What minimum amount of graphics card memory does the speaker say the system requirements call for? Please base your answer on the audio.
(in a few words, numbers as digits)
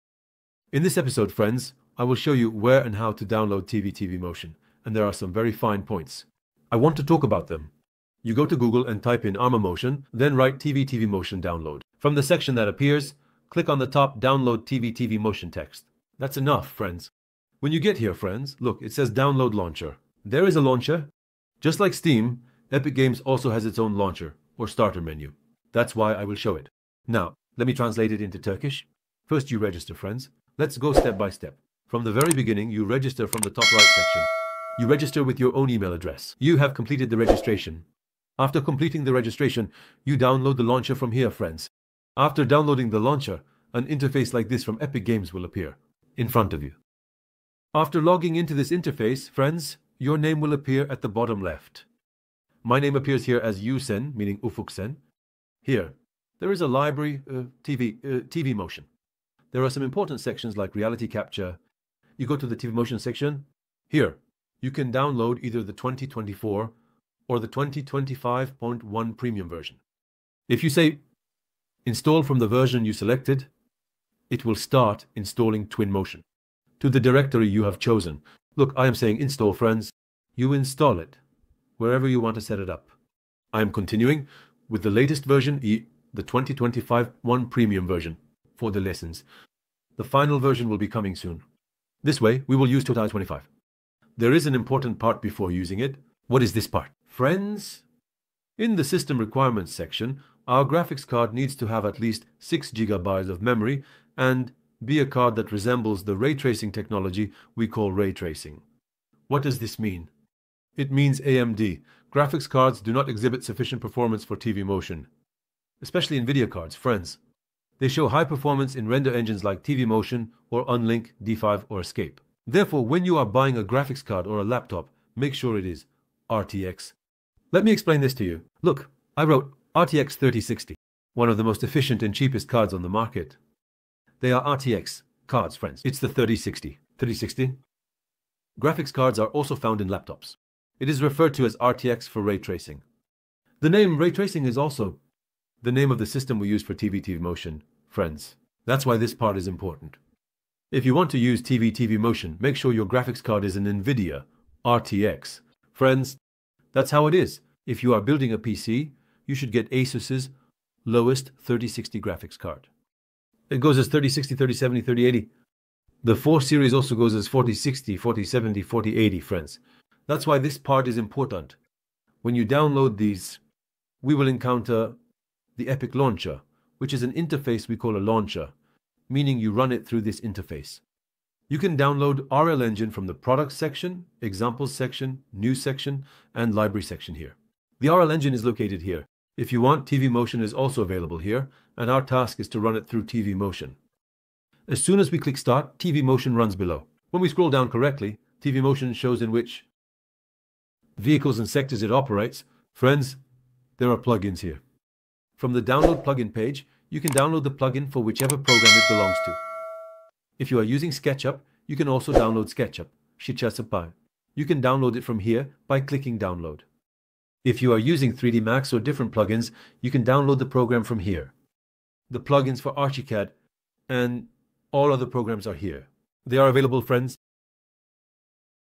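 6 GB.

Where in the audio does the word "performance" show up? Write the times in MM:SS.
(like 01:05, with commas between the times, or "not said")
01:53, 01:58.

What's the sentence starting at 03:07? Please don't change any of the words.
The RL Engine is located here.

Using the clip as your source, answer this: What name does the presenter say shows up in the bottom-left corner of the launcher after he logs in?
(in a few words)
Yusen.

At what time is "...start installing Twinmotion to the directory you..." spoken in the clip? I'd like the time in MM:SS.
01:14.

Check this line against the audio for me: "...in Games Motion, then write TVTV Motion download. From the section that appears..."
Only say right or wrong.
wrong.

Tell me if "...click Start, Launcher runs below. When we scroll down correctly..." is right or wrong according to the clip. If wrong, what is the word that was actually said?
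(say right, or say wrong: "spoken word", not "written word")
wrong: "Twinmotion", not "Launcher".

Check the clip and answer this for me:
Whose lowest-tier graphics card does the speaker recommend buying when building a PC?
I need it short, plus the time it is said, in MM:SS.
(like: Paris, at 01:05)
Asus, at 02:39.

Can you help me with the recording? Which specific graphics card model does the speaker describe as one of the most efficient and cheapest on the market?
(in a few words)
RTX 3060.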